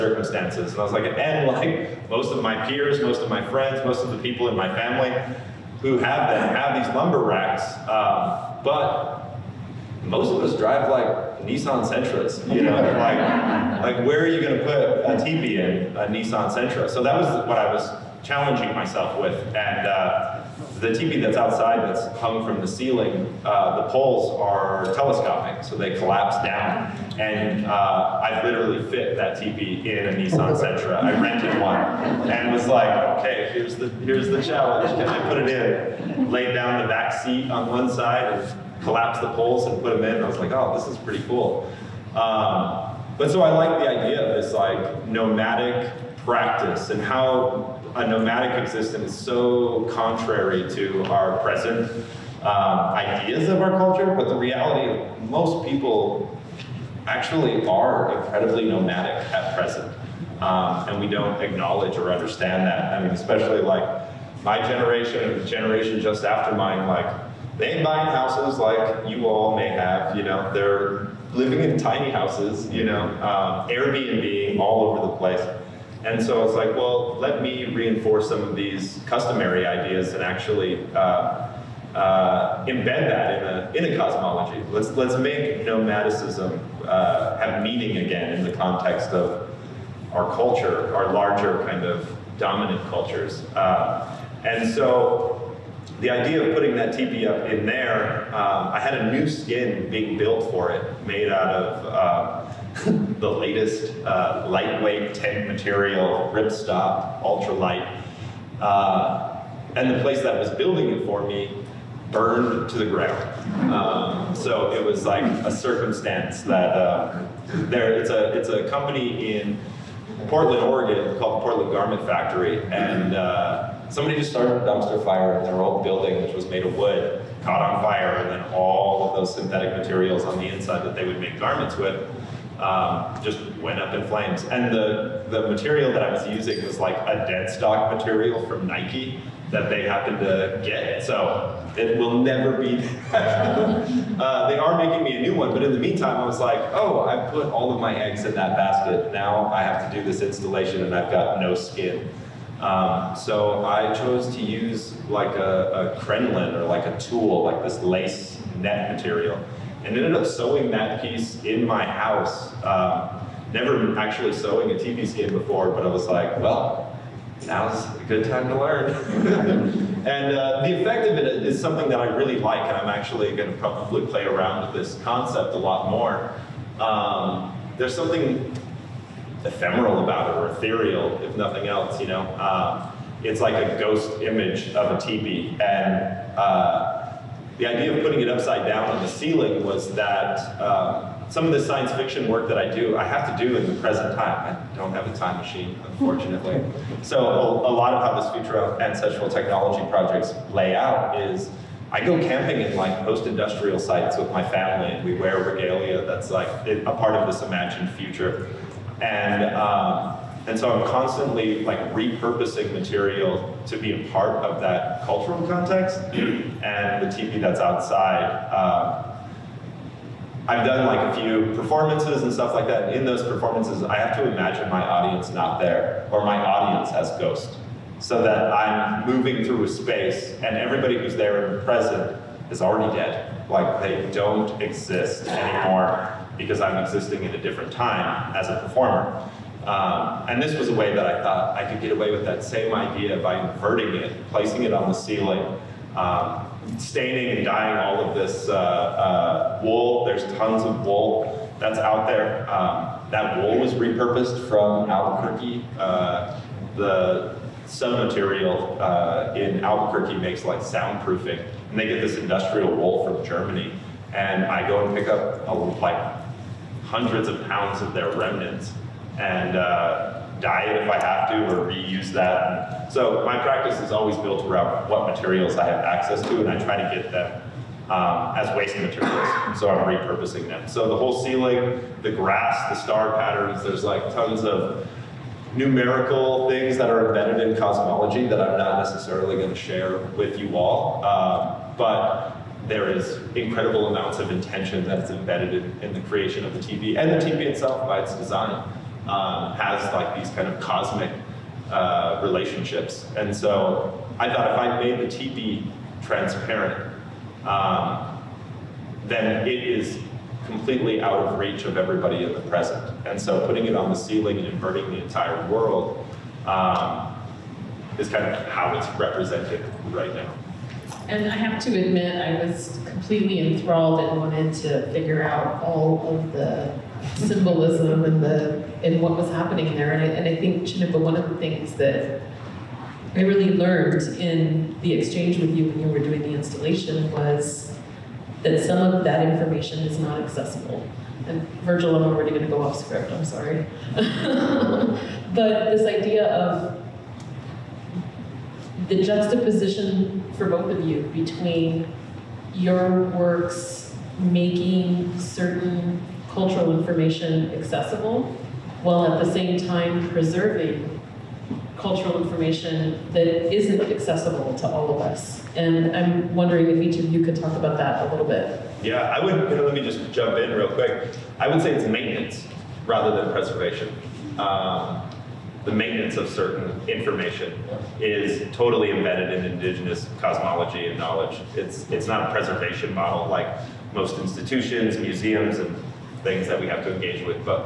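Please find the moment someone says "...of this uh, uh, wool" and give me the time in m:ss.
4:08.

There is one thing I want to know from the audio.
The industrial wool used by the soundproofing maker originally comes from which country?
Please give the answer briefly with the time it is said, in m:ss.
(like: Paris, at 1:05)
Germany, at 4:23.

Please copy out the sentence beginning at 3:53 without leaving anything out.
Like they don't exist anymore because I'm existing in a different time as a performer.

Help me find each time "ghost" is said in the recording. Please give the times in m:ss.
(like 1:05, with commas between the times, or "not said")
3:03, 3:47.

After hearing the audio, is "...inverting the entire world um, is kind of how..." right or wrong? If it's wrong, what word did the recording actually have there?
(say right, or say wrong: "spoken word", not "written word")
right.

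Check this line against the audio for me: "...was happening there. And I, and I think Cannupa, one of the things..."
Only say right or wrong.
right.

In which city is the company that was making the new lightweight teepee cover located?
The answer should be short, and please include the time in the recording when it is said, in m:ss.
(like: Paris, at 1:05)
Portland, Oregon, at 2:00.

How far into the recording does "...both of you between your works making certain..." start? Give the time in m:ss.
5:50.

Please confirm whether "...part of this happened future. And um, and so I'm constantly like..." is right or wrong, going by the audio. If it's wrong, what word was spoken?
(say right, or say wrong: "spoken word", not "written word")
wrong: "imagined", not "happened".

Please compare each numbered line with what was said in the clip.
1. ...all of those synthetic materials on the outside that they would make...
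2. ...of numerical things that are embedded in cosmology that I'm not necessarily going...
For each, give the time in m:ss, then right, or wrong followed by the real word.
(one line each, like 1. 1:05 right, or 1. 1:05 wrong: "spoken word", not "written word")
1. 2:08 wrong: "inside", not "outside"
2. 4:44 right.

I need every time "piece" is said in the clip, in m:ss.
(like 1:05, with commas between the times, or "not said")
2:40.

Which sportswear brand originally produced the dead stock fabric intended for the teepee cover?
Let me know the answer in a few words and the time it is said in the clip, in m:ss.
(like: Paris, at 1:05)
Nike, at 2:18.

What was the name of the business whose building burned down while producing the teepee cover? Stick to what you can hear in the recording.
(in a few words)
Portland Garment Factory.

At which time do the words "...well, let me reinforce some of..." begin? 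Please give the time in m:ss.
1:16.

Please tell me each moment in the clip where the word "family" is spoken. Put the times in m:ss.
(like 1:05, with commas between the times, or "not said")
0:04, 3:24.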